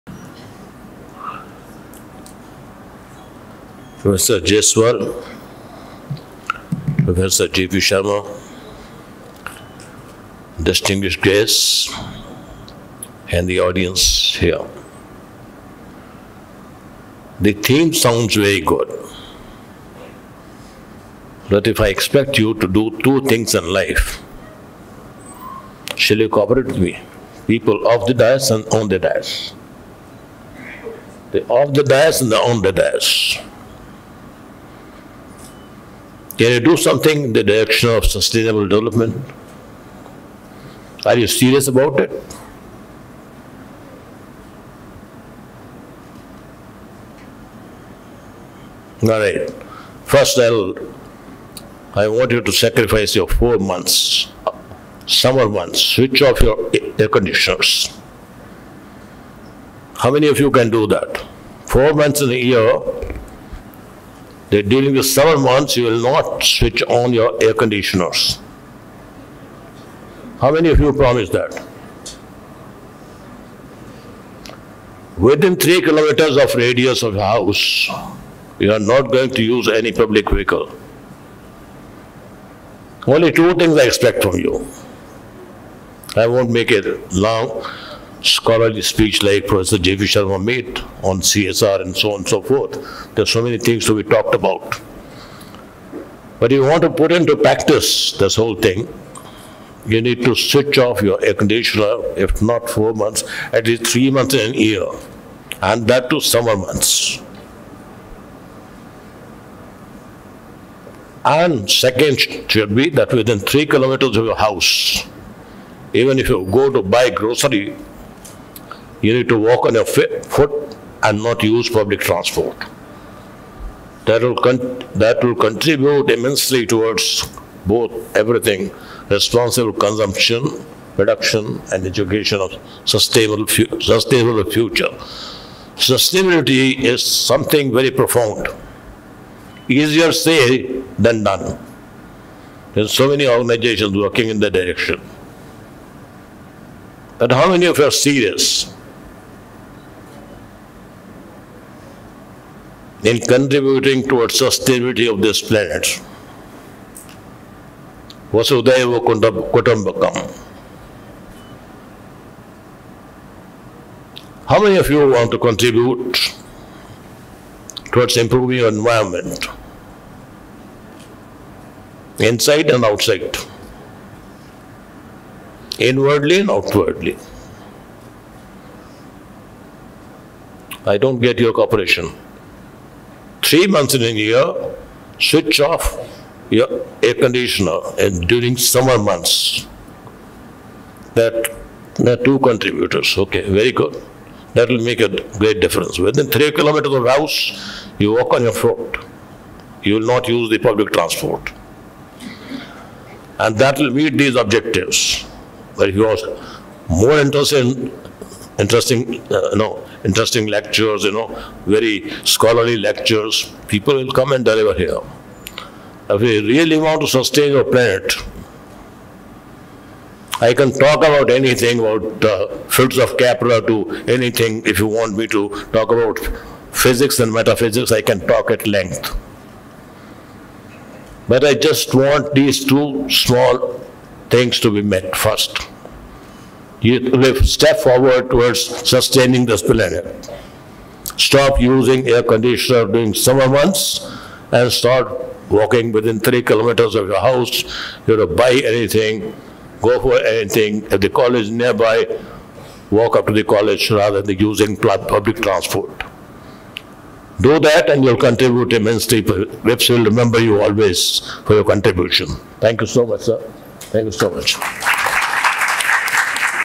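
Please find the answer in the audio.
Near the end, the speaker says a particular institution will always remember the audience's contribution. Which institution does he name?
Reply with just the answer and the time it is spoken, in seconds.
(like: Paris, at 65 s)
VIPS, at 259 s.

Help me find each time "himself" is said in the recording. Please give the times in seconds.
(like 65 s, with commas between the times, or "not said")
not said.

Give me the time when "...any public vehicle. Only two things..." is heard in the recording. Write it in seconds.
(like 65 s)
79 s.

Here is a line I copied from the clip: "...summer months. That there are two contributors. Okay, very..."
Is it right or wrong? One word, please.
right.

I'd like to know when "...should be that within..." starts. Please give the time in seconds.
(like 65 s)
112 s.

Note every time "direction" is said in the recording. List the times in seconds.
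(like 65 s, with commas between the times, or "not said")
37 s, 144 s.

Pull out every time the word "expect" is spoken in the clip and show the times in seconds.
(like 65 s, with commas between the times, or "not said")
21 s, 83 s.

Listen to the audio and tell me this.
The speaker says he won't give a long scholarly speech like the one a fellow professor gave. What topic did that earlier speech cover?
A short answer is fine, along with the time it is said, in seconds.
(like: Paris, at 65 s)
CSR, at 91 s.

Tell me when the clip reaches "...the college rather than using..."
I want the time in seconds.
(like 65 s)
253 s.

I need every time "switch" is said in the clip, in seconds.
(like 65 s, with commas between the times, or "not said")
55 s, 66 s, 100 s, 185 s.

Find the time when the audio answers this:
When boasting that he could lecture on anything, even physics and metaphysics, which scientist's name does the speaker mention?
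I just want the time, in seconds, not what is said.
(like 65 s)
223 s.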